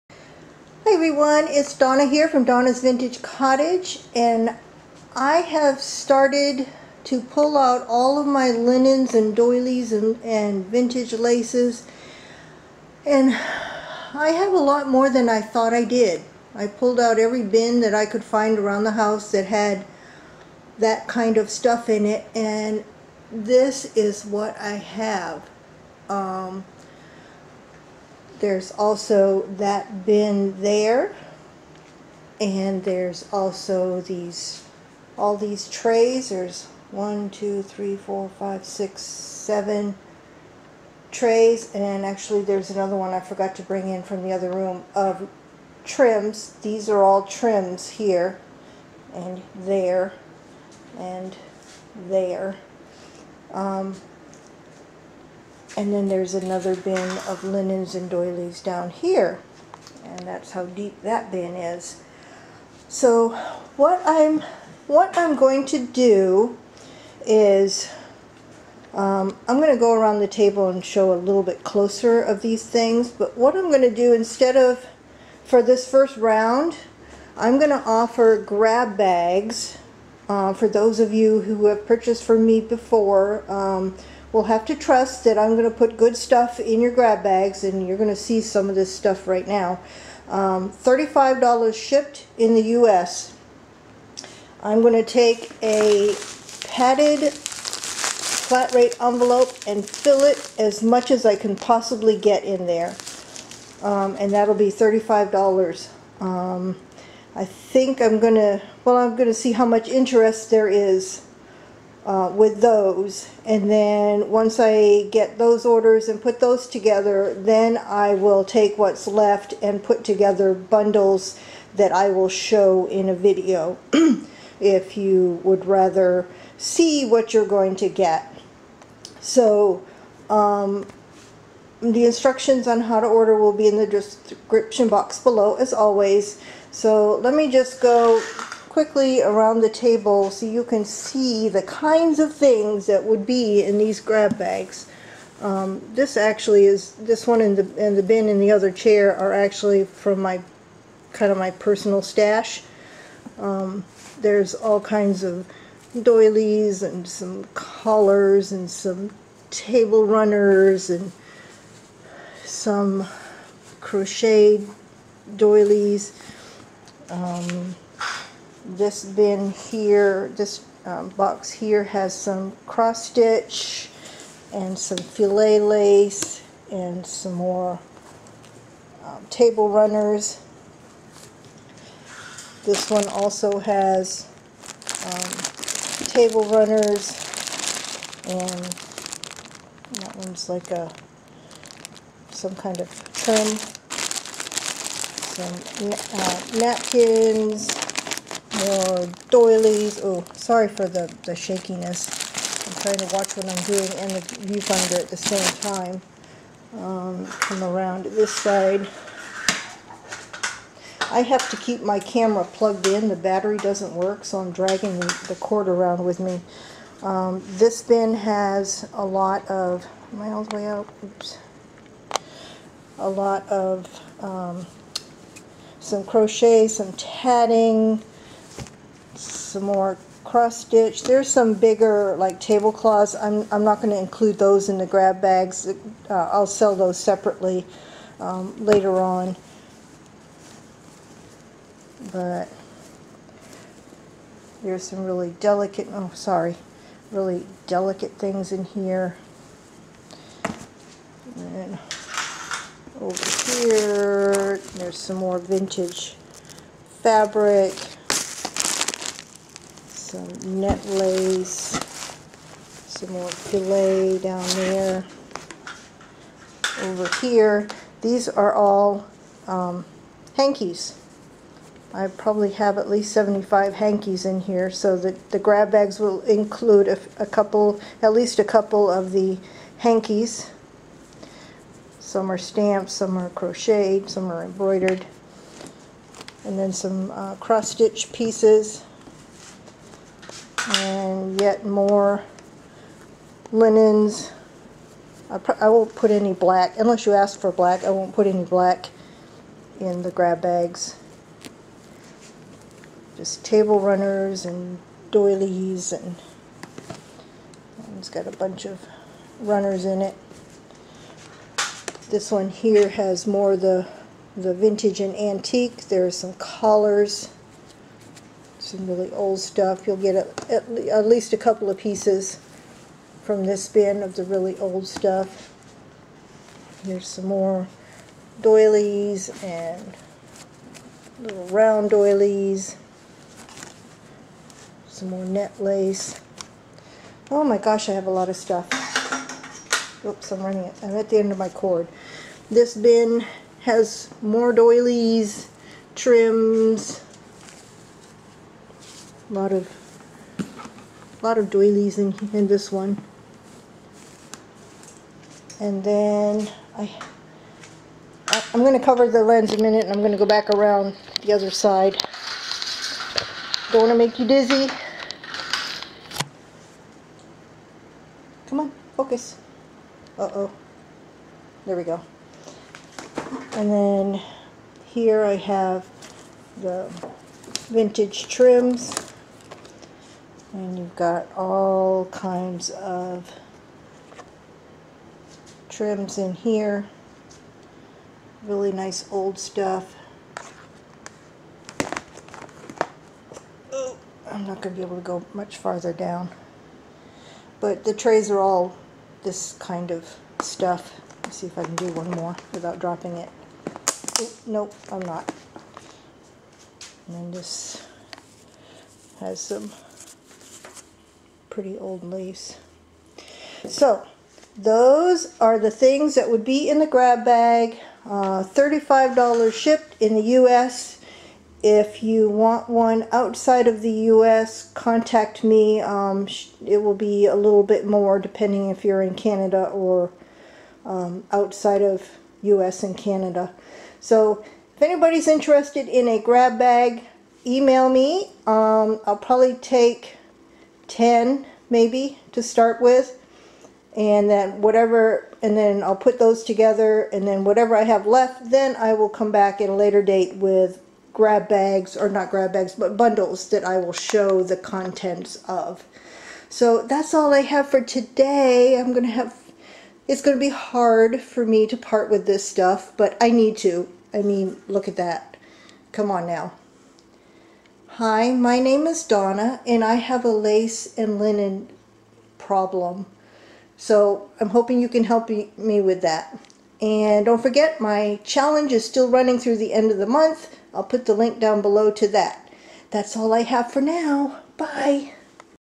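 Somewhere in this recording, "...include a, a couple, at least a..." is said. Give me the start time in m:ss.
4:36.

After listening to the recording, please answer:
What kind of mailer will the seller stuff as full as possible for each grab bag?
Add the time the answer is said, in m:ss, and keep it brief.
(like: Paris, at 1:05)
padded flat rate envelope, at 1:36.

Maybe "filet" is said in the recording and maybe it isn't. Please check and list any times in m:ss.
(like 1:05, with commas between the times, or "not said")
2:54, 4:23.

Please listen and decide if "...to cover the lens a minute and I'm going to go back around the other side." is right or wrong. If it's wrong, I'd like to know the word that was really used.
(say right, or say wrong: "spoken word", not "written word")
right.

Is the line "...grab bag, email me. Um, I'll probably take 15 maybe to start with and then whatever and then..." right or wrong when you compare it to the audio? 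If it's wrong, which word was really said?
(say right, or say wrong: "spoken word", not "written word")
wrong: "10", not "15".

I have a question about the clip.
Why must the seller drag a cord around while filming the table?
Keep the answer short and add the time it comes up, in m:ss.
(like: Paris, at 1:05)
battery doesn't work, at 3:33.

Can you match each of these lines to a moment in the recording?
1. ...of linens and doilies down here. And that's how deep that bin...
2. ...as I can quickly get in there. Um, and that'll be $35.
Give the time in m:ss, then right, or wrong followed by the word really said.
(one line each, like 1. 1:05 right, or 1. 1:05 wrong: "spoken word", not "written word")
1. 0:57 right
2. 1:41 wrong: "possibly", not "quickly".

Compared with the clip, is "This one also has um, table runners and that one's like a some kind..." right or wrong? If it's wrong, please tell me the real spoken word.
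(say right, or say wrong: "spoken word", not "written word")
right.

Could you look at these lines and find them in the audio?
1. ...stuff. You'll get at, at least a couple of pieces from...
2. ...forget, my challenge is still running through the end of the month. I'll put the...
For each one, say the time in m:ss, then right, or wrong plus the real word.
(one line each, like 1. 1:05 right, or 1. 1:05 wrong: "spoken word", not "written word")
1. 5:19 right
2. 7:57 right.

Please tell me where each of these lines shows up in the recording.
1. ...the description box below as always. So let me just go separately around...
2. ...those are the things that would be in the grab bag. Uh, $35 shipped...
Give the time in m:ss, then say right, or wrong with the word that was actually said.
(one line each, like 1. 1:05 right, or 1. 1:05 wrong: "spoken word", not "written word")
1. 2:13 wrong: "quickly", not "separately"
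2. 6:54 right.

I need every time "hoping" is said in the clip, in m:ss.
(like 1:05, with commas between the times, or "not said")
7:54.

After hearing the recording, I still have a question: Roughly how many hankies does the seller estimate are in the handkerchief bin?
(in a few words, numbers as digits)
75.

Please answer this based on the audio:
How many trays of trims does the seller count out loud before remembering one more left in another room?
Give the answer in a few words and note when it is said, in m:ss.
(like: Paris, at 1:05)
7, at 0:39.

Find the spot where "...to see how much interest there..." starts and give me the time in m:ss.
1:49.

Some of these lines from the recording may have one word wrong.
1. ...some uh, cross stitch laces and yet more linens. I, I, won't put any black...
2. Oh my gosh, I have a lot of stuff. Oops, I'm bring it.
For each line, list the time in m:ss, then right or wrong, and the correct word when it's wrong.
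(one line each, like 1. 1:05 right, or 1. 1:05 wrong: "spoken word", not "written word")
1. 4:46 wrong: "pieces", not "laces"
2. 5:37 wrong: "running", not "bring".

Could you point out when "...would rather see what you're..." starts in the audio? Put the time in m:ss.
2:05.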